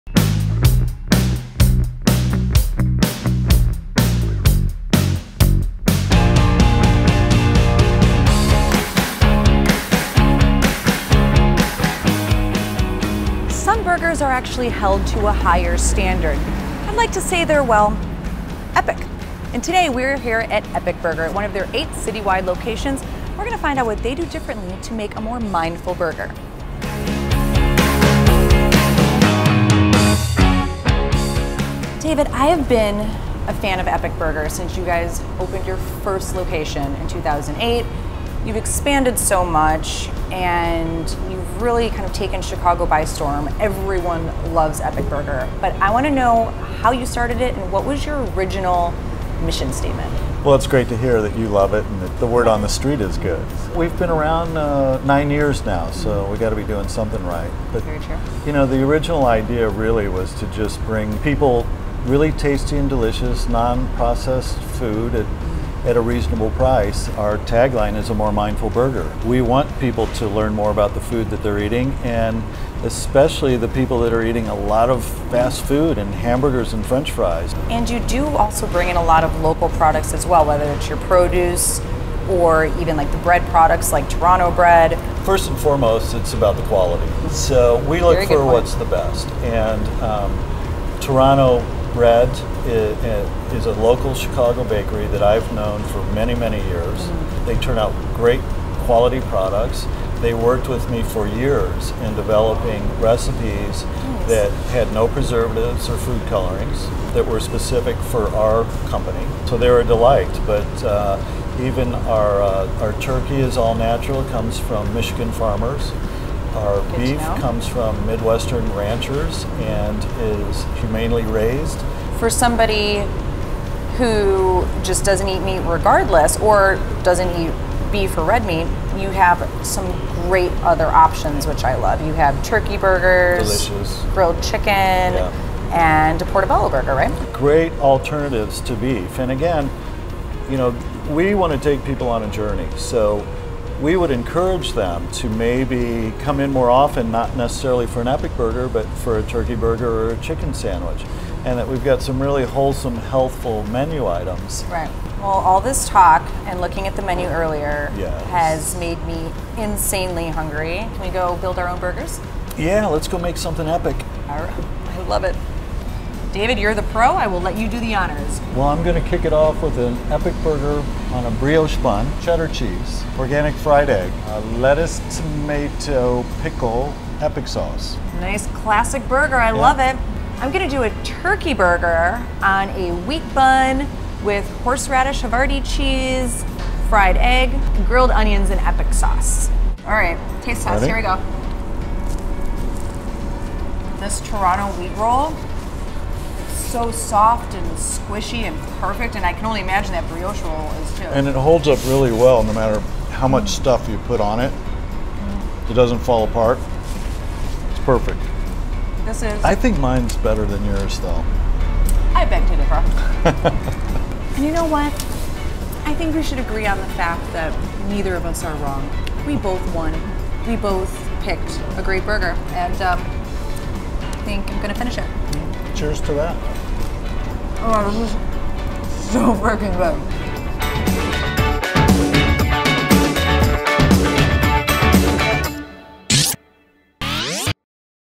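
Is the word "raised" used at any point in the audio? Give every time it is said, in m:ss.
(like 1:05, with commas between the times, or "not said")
2:01.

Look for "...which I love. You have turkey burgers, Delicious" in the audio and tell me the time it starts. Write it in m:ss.
2:11.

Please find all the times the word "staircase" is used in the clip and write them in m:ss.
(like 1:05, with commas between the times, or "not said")
not said.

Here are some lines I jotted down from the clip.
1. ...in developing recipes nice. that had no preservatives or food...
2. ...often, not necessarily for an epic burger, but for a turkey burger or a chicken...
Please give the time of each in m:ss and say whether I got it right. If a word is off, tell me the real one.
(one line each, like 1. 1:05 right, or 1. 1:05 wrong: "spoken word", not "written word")
1. 1:42 right
2. 2:26 right.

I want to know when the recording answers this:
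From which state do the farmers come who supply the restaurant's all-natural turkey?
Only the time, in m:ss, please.
1:54.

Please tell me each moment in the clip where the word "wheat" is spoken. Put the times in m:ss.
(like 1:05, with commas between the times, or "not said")
3:03, 3:14.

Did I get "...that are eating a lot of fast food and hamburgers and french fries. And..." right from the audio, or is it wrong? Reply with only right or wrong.
right.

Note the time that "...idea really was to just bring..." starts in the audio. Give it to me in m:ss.
0:59.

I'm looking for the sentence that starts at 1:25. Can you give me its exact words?
First and foremost, it's about the quality.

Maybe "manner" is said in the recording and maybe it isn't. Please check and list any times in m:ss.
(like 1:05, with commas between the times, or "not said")
not said.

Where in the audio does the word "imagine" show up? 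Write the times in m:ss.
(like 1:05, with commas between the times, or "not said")
3:19.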